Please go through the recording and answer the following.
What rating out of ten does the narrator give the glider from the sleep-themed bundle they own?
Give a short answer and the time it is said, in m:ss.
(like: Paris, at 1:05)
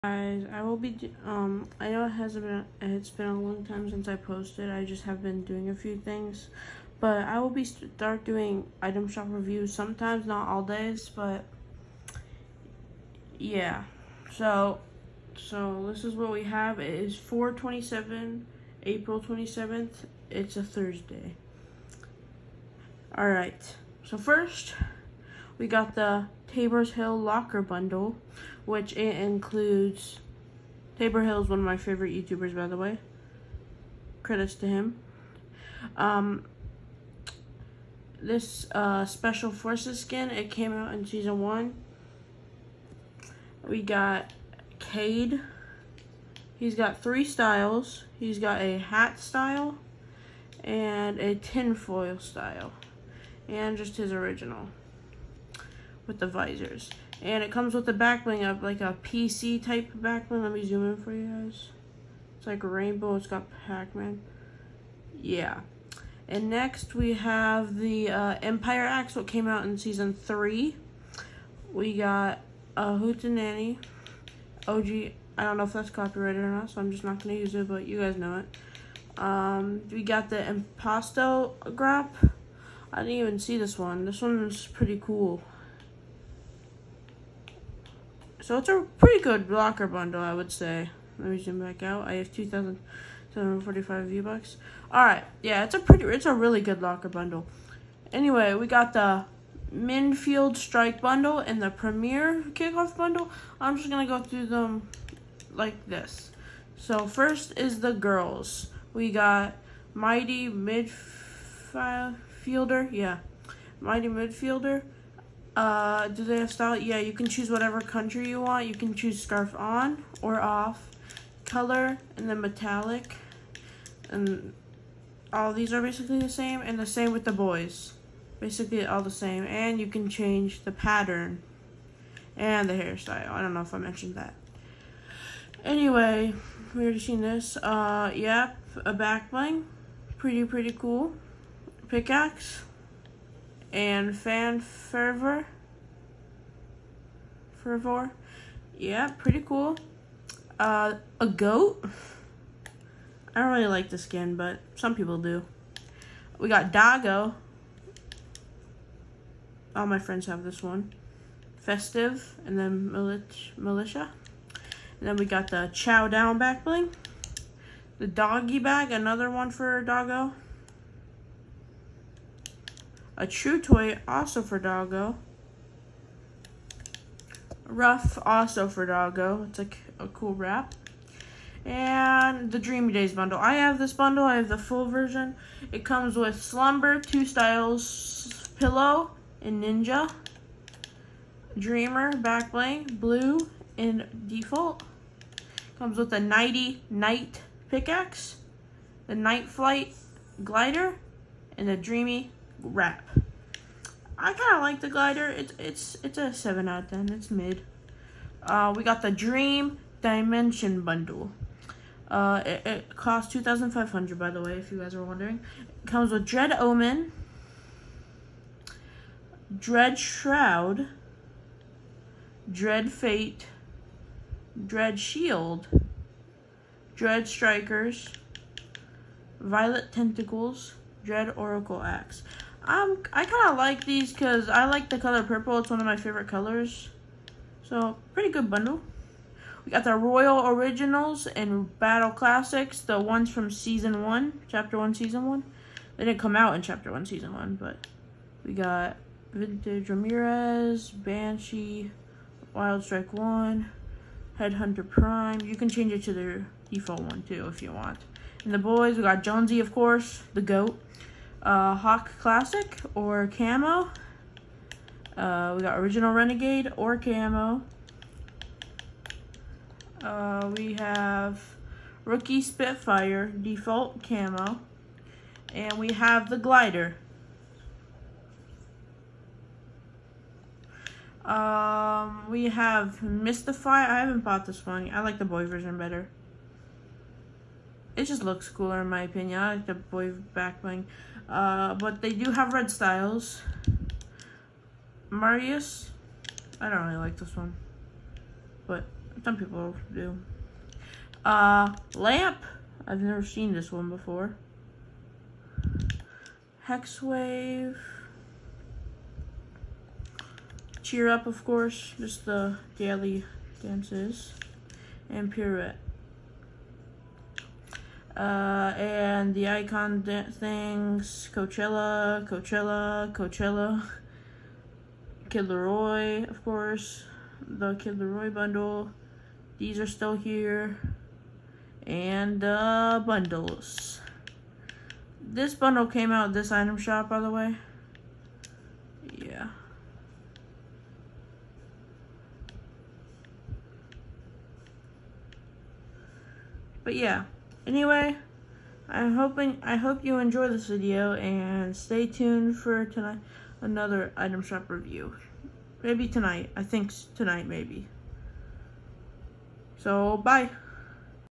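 7, at 3:26.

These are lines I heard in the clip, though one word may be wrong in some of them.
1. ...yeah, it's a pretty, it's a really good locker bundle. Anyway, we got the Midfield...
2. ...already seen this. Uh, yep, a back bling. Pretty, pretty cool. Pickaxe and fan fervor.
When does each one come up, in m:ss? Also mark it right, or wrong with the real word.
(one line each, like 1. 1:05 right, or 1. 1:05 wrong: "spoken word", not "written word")
1. 1:35 right
2. 2:16 right.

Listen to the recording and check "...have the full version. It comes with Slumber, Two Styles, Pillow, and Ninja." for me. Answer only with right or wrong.
right.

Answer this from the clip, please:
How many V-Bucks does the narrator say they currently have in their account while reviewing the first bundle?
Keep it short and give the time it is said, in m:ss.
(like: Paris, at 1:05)
2,745, at 1:32.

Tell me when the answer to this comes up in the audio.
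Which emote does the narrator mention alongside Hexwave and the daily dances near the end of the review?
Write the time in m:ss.
5:15.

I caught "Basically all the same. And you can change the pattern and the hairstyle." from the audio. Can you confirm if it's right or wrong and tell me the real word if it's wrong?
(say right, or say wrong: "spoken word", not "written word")
right.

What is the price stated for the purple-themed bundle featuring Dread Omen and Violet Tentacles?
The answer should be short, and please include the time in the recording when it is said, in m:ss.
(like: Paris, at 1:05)
2,500, at 3:33.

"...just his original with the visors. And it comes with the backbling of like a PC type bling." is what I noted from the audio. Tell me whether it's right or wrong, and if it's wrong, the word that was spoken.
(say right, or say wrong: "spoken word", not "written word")
wrong: "backbling", not "bling".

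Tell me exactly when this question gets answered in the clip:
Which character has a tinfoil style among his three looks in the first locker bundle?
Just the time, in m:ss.
0:44.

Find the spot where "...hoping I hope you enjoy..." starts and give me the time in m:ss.
5:49.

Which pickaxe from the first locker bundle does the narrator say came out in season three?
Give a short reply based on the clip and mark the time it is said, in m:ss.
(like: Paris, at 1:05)
Empire Axe, at 1:08.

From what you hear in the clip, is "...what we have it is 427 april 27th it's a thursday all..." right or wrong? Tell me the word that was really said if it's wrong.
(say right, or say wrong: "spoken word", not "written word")
right.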